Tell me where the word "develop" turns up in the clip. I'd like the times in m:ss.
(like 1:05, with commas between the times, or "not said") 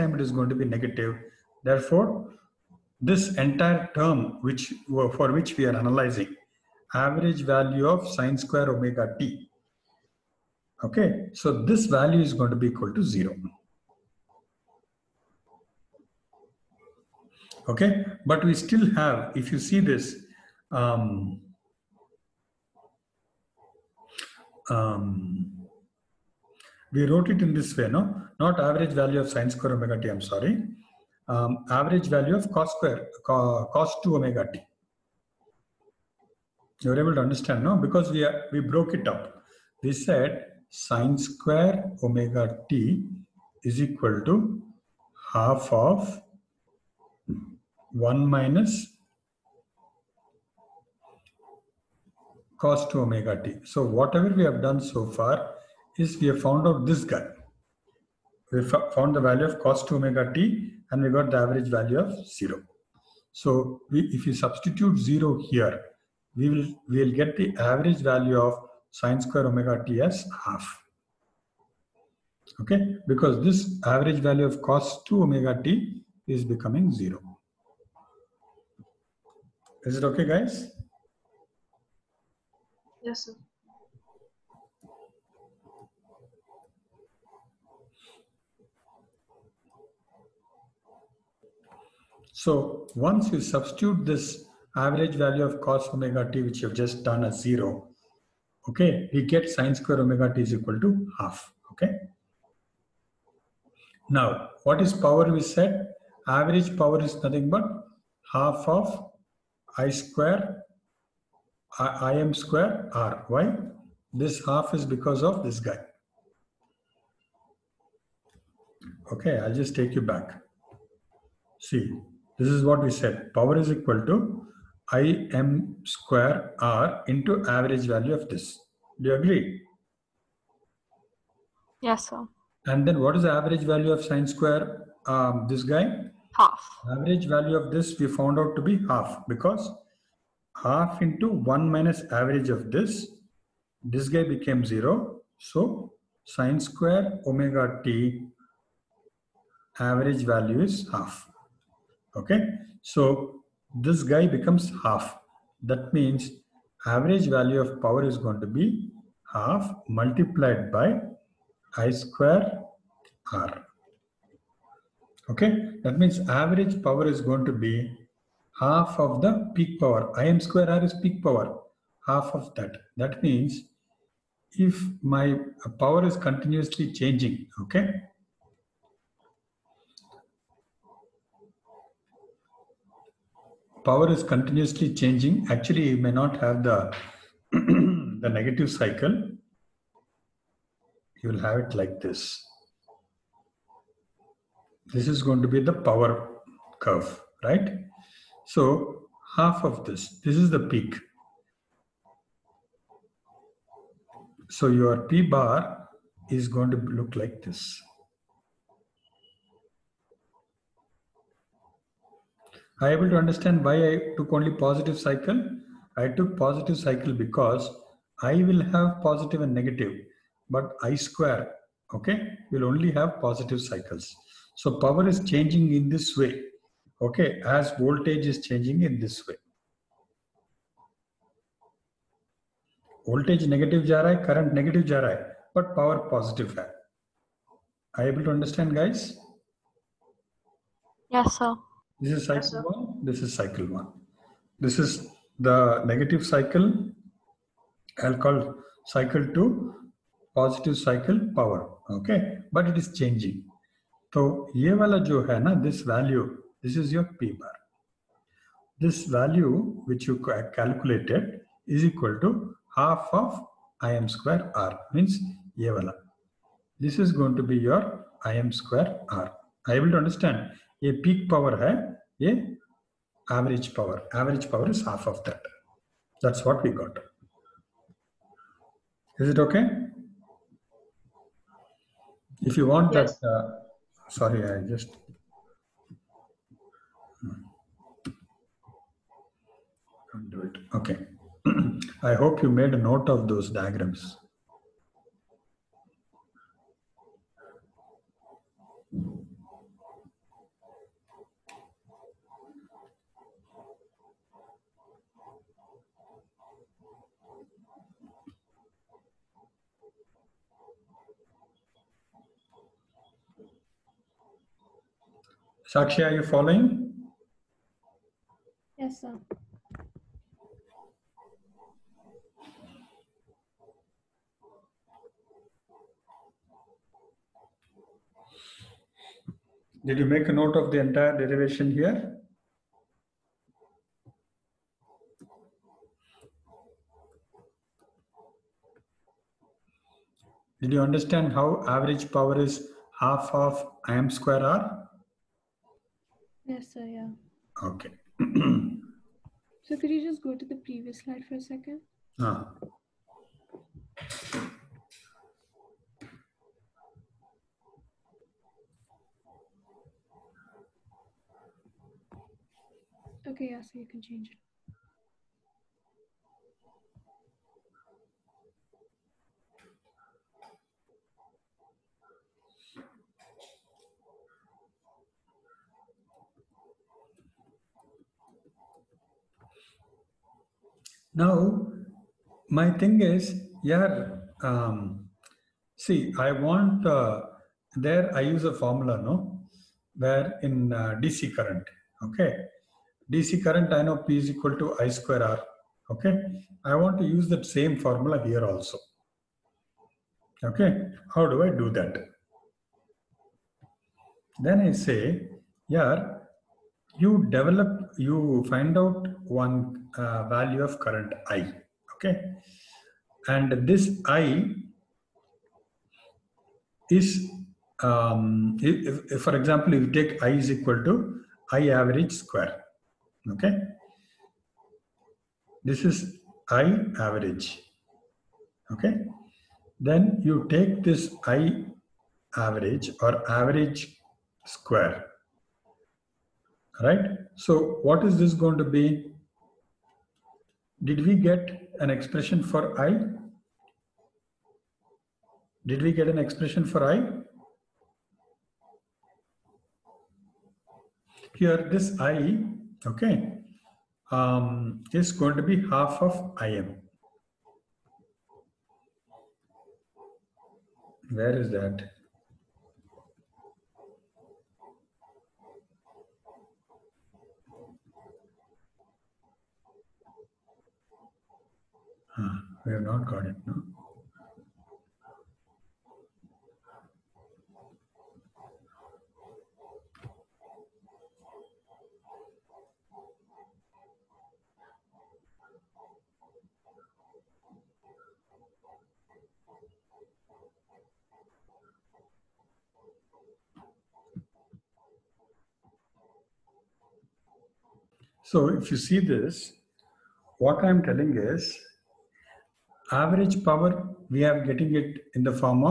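6:47.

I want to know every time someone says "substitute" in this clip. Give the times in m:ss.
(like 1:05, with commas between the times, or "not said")
1:04, 1:33.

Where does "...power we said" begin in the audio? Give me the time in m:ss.
1:44.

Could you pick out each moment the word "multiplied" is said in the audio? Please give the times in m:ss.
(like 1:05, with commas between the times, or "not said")
2:39.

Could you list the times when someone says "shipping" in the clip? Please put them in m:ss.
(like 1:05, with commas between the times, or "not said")
not said.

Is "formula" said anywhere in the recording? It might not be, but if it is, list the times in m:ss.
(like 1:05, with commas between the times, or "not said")
6:28, 6:37.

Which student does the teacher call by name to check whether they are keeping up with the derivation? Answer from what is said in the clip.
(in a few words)
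Sakshi.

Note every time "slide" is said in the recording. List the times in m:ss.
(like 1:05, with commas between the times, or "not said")
5:50.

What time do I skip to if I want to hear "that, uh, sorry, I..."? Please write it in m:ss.
4:43.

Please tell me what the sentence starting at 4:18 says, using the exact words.
This value which you calculated is equal to half of Im square R means Yevala.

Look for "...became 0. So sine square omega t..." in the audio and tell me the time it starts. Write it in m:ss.
2:24.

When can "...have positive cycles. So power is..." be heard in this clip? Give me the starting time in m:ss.
3:42.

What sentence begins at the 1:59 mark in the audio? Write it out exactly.
Okay, I'll just take you back.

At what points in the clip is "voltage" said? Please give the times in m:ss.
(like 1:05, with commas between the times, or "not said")
3:47, 3:53.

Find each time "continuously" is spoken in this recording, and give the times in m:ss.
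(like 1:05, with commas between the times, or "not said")
2:56, 3:04.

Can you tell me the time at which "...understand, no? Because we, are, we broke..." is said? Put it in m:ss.
0:37.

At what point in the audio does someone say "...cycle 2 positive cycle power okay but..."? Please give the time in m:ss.
4:08.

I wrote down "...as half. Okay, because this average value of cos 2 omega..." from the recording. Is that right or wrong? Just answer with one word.
right.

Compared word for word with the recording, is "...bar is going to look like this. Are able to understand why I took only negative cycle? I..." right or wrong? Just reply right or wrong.
wrong.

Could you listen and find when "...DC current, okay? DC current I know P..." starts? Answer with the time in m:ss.
6:31.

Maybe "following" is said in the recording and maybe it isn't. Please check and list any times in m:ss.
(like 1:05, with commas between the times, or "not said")
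5:16.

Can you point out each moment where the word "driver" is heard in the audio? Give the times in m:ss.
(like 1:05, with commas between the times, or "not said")
not said.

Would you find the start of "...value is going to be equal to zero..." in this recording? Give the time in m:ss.
0:11.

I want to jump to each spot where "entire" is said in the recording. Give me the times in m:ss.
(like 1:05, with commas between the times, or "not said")
0:03, 5:30.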